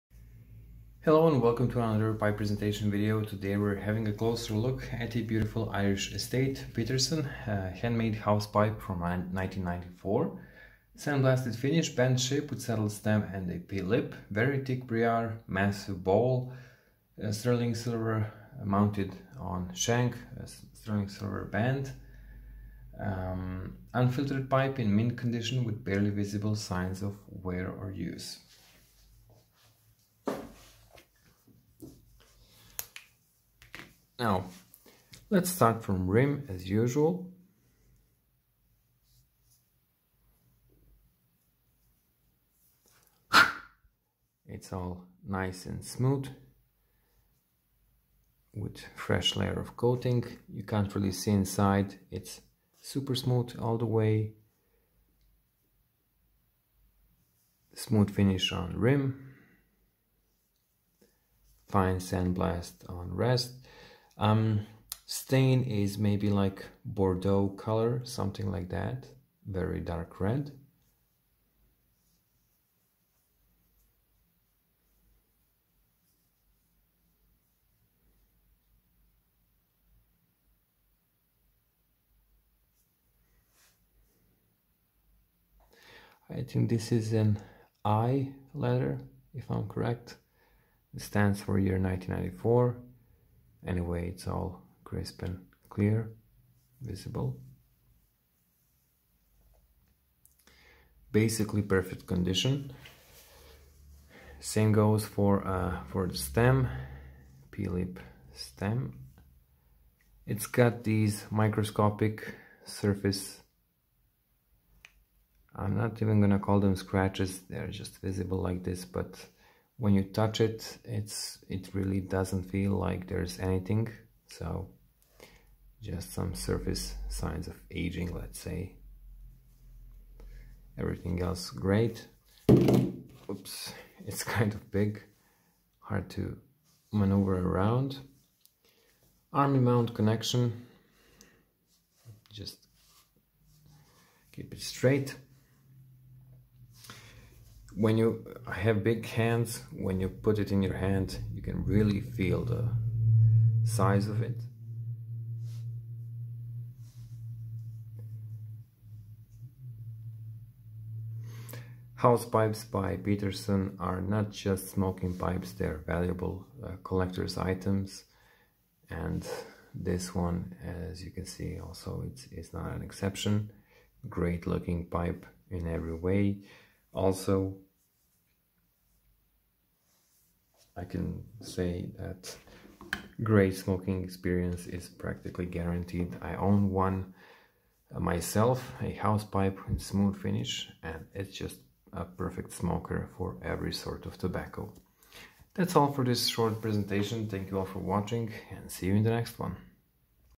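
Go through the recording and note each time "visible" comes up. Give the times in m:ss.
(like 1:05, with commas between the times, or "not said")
0:26, 1:36, 1:57.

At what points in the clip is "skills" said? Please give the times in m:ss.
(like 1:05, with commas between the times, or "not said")
not said.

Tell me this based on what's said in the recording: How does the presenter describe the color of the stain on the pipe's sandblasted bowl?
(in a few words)
Bordeaux.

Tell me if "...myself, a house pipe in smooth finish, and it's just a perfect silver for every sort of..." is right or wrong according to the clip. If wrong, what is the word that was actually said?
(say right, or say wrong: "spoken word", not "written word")
wrong: "smoker", not "silver".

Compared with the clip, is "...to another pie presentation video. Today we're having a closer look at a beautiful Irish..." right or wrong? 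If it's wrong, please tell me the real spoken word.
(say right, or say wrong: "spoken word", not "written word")
right.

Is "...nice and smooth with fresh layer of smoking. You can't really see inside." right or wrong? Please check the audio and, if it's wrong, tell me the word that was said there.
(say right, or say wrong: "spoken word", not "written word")
wrong: "coating", not "smoking".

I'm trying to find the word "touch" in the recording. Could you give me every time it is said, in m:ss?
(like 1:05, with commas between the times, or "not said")
2:00.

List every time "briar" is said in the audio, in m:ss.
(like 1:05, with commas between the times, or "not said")
0:14.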